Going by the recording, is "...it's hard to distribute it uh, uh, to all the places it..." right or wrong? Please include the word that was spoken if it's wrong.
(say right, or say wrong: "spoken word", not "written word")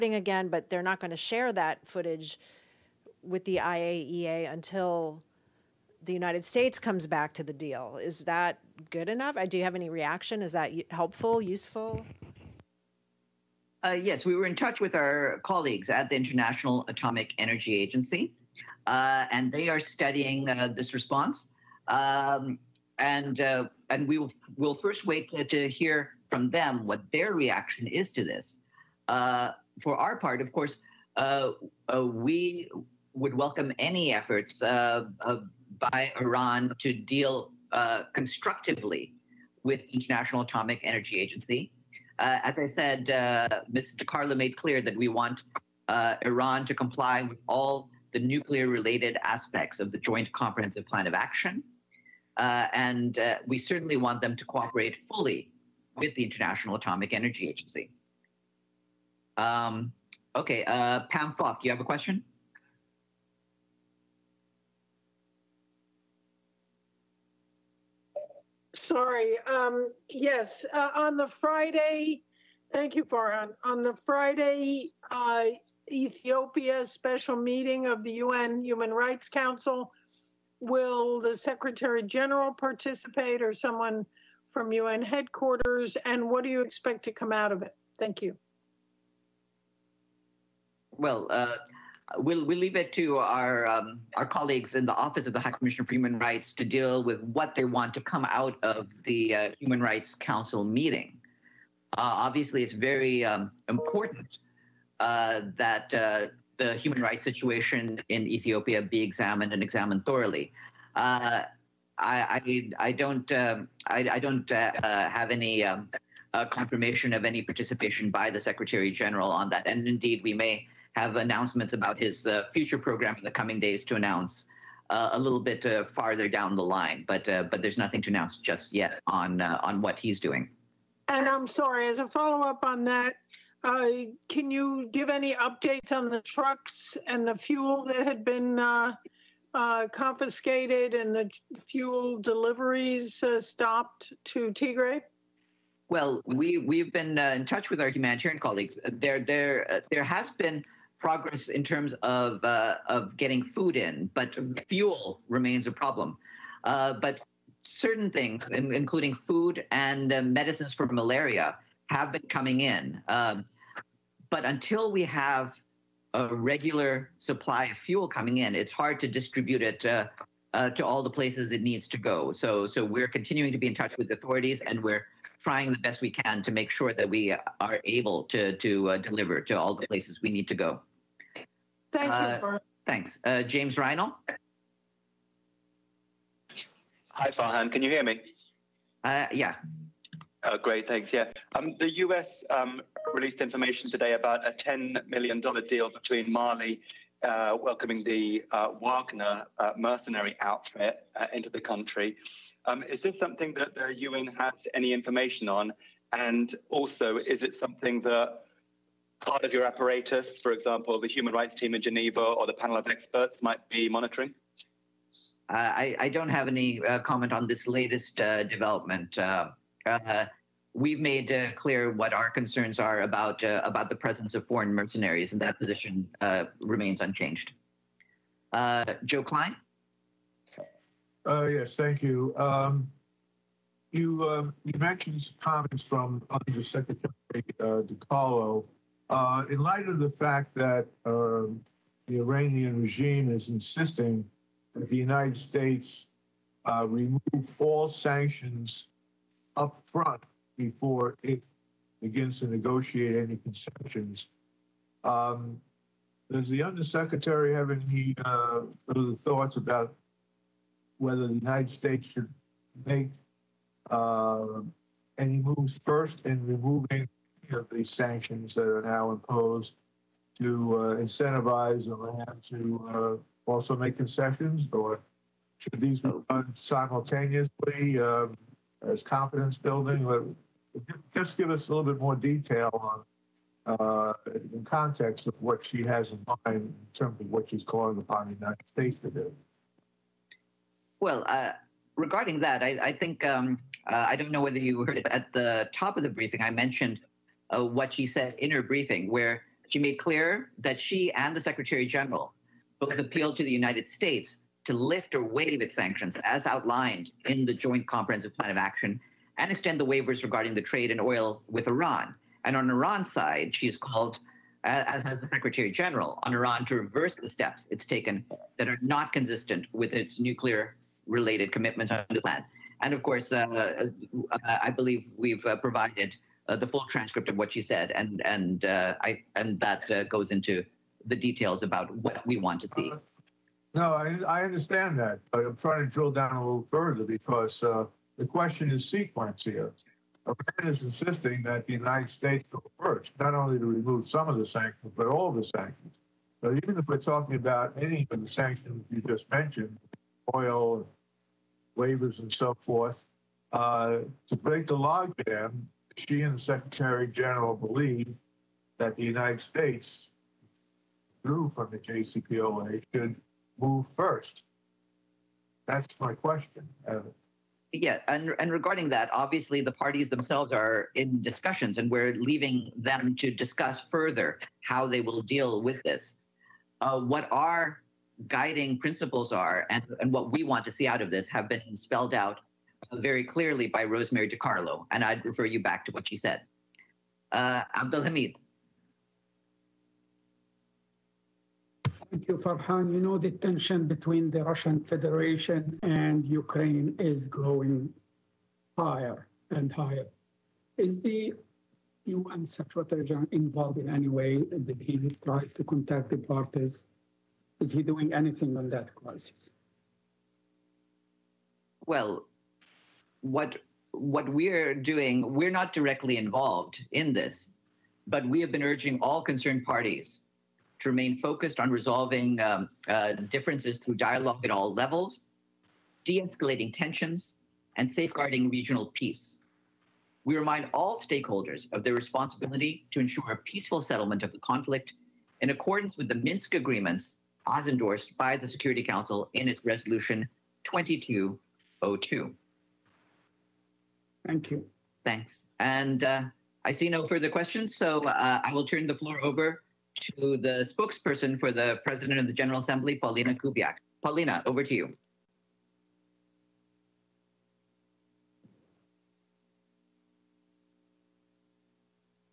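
right.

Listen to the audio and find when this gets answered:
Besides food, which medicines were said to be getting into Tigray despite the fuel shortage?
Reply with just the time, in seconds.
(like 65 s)
160 s.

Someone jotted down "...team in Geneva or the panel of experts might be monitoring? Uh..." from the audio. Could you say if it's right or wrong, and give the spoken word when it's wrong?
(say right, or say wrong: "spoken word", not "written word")
right.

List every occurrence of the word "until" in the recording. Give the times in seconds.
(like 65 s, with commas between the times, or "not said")
4 s, 164 s.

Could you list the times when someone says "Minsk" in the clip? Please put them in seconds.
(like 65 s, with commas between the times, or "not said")
436 s.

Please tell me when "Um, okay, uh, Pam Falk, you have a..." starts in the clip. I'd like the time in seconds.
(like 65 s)
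59 s.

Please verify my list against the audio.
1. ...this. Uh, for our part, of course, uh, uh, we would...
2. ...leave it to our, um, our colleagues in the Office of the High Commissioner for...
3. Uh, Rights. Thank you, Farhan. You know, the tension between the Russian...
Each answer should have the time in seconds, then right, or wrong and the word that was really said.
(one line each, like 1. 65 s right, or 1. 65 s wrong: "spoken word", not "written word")
1. 28 s right
2. 92 s right
3. 387 s wrong: "Hamid", not "Rights".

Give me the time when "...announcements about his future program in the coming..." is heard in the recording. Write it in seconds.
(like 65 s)
121 s.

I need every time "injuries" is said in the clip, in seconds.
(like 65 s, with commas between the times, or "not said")
not said.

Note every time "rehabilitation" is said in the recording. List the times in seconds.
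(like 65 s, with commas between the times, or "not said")
not said.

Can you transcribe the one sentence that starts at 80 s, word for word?
Will the Secretary General participate or someone from UN headquarters?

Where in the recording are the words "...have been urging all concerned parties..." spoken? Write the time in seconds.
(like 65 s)
418 s.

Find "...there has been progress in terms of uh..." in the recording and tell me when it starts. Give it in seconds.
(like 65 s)
149 s.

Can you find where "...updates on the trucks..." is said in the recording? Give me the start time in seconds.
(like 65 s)
135 s.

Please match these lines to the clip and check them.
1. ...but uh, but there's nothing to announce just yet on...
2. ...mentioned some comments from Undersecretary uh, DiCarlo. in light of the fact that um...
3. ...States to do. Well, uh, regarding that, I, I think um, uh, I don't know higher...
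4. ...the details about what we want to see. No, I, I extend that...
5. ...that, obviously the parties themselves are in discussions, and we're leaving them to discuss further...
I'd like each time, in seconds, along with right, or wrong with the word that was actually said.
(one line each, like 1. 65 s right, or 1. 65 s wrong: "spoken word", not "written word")
1. 127 s right
2. 234 s right
3. 288 s wrong: "whether", not "higher"
4. 331 s wrong: "understand", not "extend"
5. 368 s right.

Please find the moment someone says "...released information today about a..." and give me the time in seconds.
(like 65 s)
193 s.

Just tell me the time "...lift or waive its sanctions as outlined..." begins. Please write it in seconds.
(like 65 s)
304 s.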